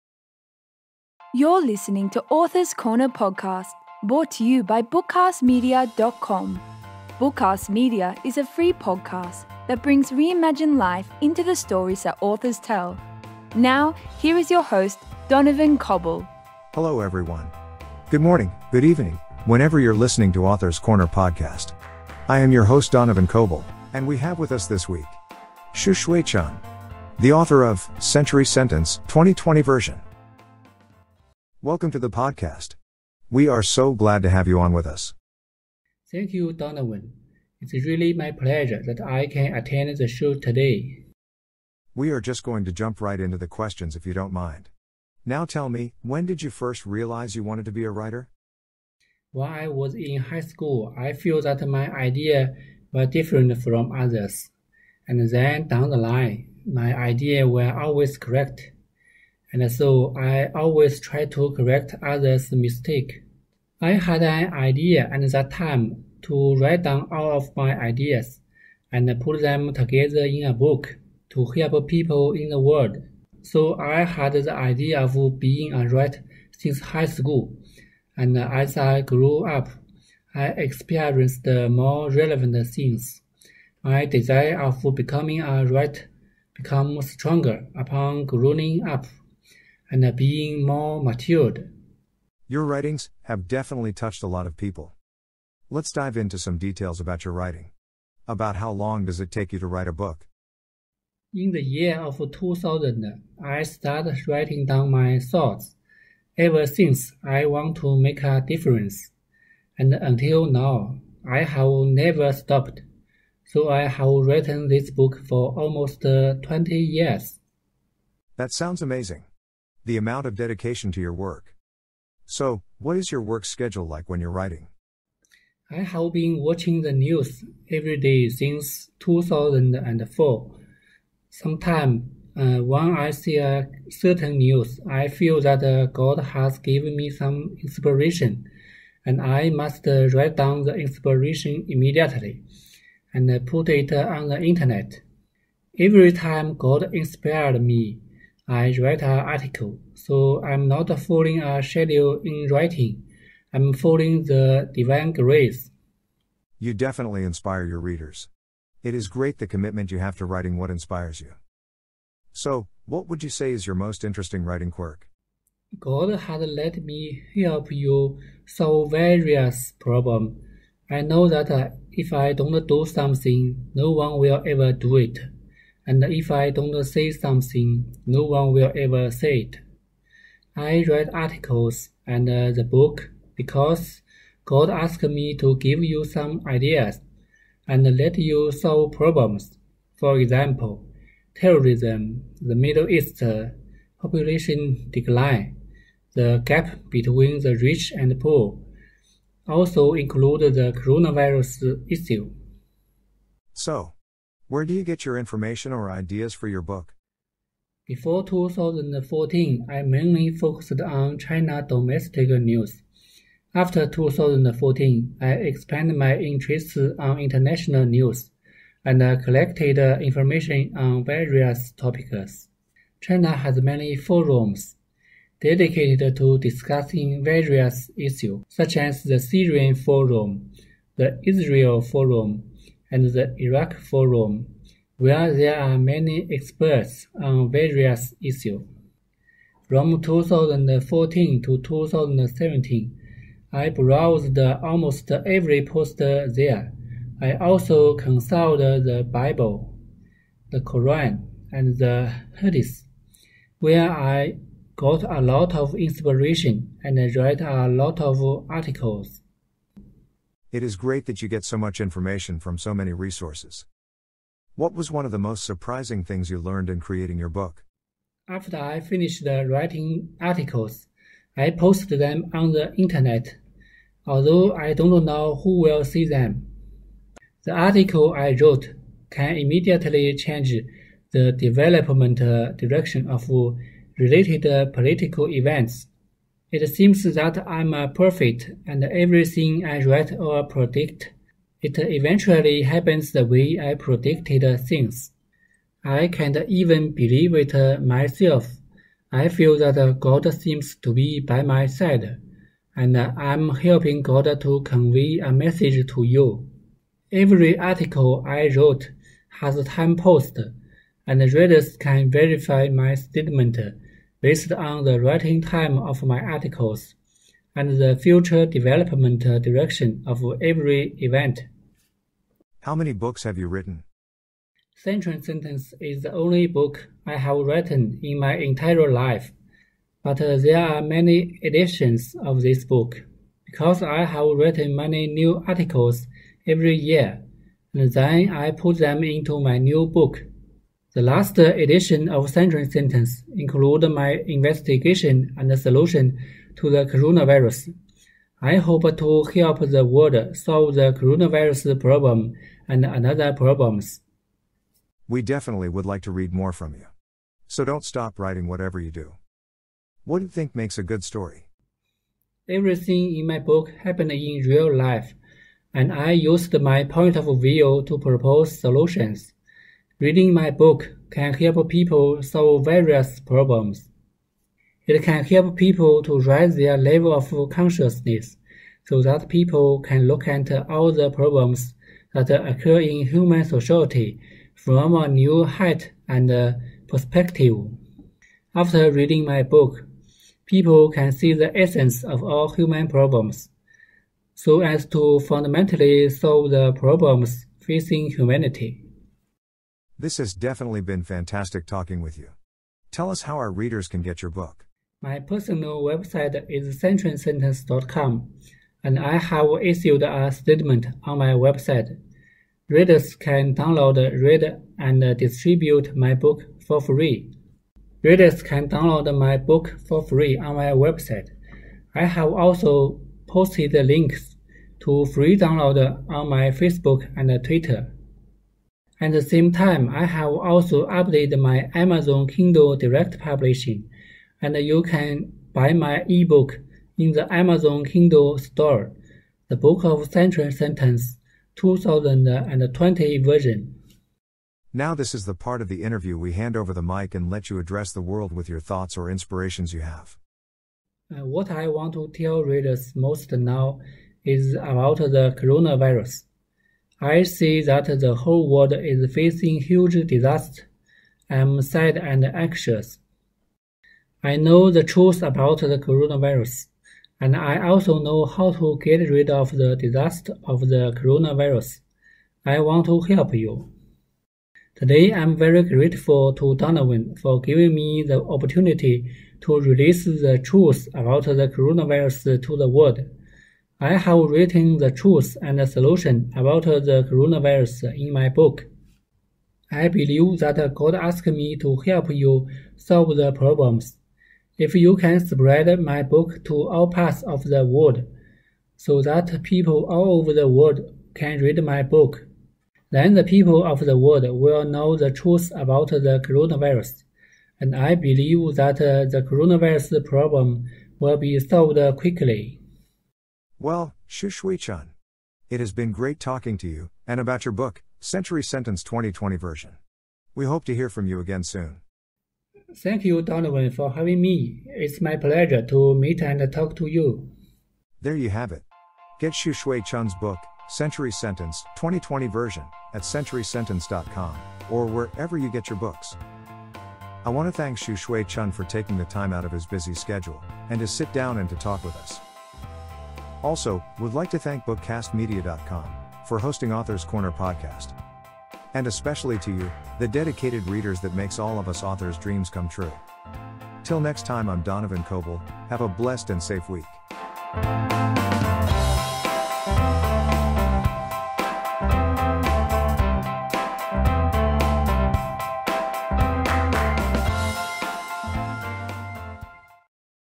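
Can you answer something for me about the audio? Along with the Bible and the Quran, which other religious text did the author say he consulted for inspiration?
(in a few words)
The Hadith.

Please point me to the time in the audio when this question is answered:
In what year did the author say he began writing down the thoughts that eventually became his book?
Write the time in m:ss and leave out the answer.
1:42.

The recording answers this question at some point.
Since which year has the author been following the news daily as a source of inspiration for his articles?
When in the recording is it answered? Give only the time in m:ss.
2:08.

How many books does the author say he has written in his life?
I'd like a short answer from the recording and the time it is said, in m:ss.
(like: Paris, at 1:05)
1, at 5:26.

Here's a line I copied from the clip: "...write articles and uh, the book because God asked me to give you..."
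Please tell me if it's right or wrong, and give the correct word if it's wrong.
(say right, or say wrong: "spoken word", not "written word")
right.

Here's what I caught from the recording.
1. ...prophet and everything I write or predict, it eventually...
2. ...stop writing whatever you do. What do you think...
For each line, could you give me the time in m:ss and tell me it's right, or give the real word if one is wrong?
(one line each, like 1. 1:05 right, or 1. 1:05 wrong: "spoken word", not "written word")
1. 4:47 right
2. 5:57 right.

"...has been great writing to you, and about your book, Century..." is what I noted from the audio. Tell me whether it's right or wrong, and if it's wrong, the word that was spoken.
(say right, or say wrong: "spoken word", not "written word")
wrong: "talking", not "writing".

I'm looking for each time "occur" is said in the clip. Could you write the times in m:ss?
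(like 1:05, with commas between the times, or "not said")
6:22.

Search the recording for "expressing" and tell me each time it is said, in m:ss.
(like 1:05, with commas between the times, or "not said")
not said.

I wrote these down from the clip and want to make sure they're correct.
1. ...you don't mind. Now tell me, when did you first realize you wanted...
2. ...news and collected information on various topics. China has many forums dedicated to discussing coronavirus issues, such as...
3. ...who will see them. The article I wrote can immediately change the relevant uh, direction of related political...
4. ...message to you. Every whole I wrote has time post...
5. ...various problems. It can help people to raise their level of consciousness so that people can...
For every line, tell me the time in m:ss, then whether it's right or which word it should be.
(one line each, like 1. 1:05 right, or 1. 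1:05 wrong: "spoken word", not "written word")
1. 0:44 right
2. 3:37 wrong: "various", not "coronavirus"
3. 4:35 wrong: "development", not "relevant"
4. 5:05 wrong: "article", not "whole"
5. 6:12 right.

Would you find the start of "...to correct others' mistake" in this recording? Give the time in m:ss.
1:01.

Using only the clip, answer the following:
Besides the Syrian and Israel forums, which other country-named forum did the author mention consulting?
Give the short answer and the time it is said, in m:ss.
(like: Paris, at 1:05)
The Iraq Forum, at 3:53.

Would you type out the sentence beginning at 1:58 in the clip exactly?
That sounds amazing the amount of dedication to your work.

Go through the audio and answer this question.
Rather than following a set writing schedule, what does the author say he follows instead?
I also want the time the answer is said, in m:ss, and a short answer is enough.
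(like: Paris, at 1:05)
The divine grace, at 2:34.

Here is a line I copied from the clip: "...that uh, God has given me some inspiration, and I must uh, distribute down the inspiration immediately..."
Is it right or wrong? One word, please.
wrong.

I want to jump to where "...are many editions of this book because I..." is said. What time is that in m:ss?
5:30.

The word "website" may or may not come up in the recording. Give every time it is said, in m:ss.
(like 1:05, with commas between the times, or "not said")
6:45, 6:51, 7:00.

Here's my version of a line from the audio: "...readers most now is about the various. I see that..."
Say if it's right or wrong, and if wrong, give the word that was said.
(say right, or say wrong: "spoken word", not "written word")
wrong: "coronavirus", not "various".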